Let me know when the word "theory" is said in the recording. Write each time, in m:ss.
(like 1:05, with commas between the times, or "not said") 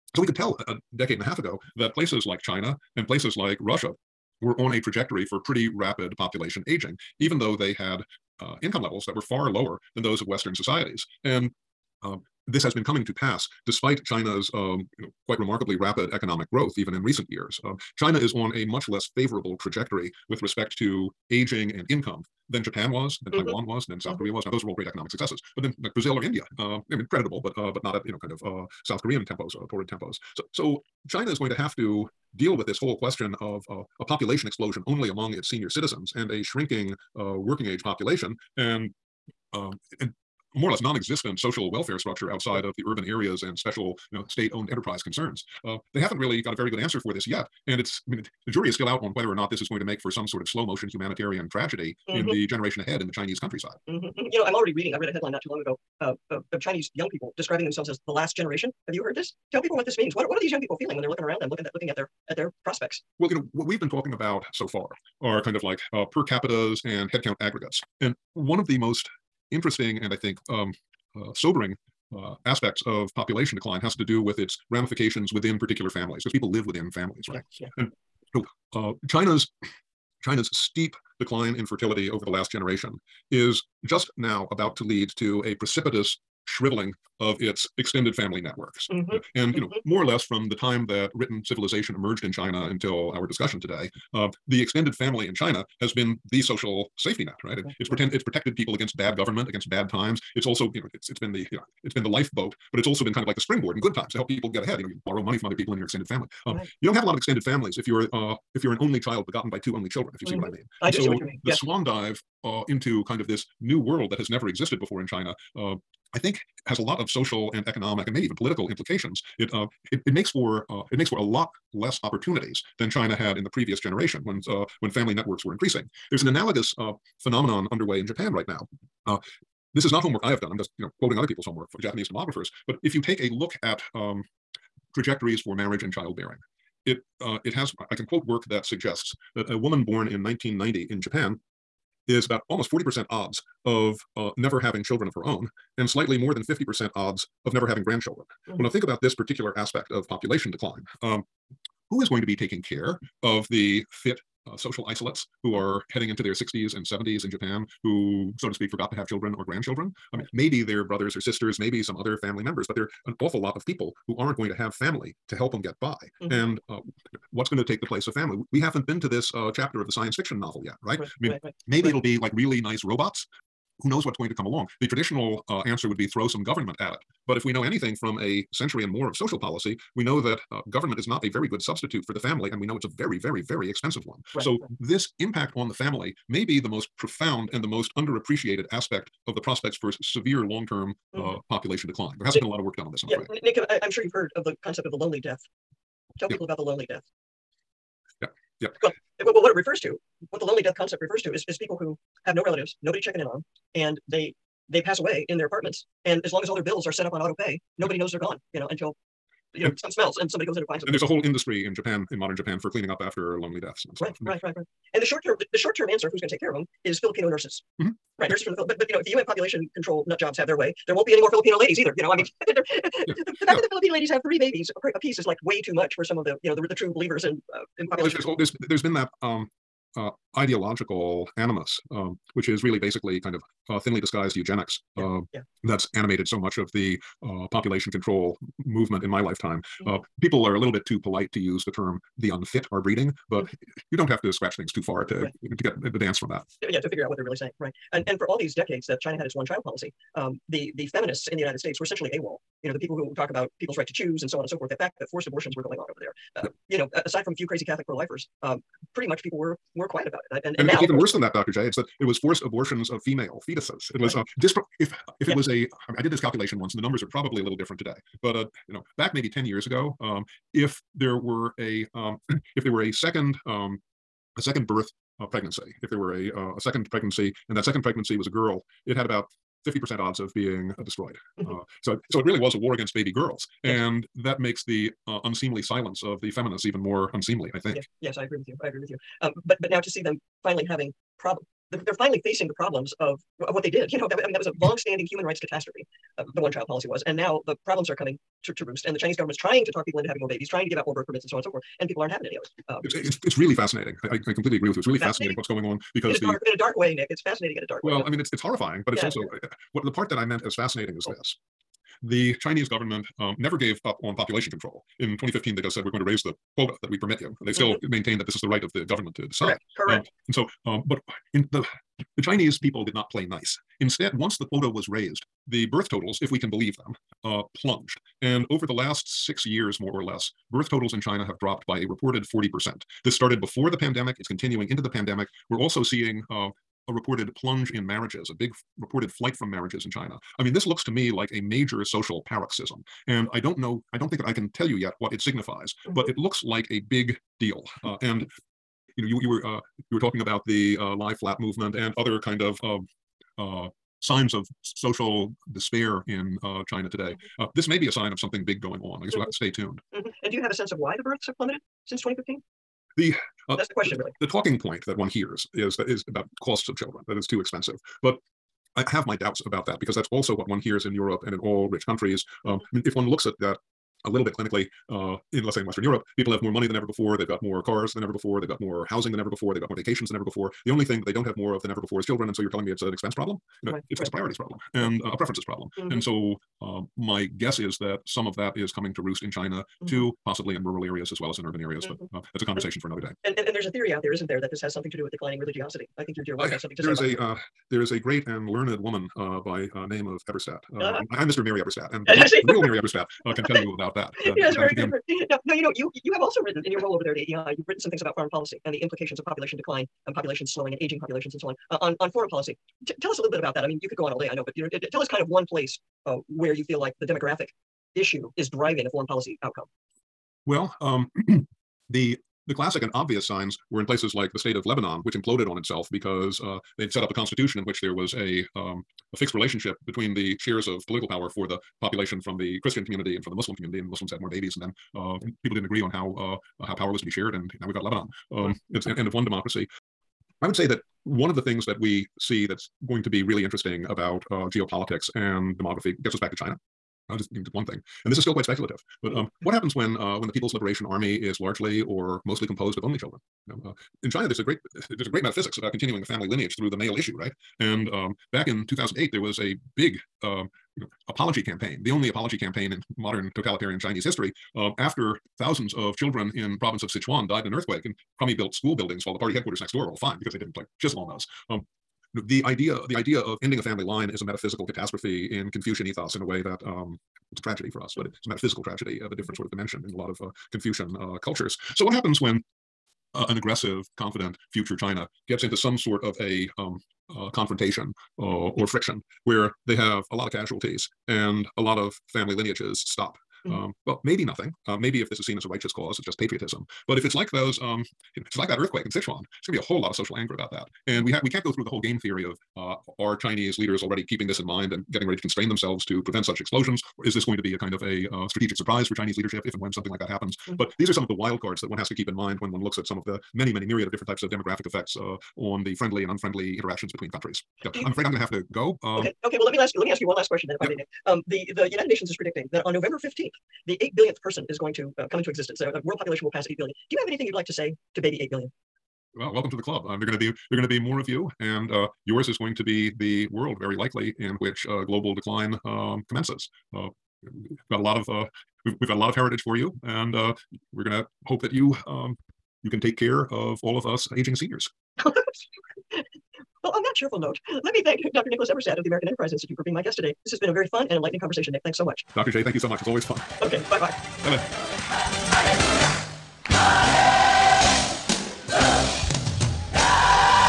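6:33, 8:21.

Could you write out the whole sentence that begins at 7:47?
And crummy built school buildings while the party headquarters next door were all fine because they didn't like chisel on those.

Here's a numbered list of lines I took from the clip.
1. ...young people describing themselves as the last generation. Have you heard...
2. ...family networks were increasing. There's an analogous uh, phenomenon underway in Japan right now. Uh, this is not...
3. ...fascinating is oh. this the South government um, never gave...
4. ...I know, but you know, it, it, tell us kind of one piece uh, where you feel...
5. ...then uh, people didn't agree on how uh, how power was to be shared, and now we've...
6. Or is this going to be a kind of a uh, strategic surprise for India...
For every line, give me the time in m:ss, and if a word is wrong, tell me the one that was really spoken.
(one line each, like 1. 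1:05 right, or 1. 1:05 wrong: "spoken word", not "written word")
1. 0:56 right
2. 2:04 right
3. 5:10 wrong: "Chinese", not "South"
4. 6:54 wrong: "place", not "piece"
5. 7:14 right
6. 8:26 wrong: "Chinese", not "India".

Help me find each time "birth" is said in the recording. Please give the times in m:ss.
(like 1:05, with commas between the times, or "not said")
4:34, 5:00, 5:25, 5:30, 6:01.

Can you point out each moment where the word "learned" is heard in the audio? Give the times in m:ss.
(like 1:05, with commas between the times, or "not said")
6:38.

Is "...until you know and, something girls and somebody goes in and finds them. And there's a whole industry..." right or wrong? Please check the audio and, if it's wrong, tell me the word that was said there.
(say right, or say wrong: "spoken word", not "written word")
wrong: "smells", not "girls".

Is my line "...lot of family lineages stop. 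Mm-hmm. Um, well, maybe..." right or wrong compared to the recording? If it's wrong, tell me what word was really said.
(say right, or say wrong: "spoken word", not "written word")
right.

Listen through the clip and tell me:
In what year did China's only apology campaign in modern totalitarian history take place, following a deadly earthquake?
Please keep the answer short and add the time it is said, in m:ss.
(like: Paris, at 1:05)
2008, at 7:38.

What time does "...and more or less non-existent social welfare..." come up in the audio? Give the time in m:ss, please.
0:39.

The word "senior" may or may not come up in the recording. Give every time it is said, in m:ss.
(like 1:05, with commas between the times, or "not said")
0:35, 9:04.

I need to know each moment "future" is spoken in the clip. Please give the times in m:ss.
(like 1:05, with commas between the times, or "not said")
8:04.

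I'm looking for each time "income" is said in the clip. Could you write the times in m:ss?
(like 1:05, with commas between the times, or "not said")
0:08, 0:21.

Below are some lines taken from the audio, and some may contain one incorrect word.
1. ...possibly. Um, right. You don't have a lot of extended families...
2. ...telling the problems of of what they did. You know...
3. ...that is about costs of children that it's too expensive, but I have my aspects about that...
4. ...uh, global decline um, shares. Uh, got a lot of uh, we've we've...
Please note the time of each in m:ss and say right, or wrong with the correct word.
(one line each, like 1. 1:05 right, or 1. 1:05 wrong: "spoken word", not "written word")
1. 1:46 wrong: "family", not "possibly"
2. 4:52 wrong: "facing", not "telling"
3. 6:05 wrong: "doubts", not "aspects"
4. 8:54 wrong: "commences", not "shares".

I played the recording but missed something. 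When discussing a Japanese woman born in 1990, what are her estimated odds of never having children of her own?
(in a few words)
almost 40%.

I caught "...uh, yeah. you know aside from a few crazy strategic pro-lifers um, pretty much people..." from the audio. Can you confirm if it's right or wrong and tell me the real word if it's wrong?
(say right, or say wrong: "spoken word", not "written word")
wrong: "catholic", not "strategic".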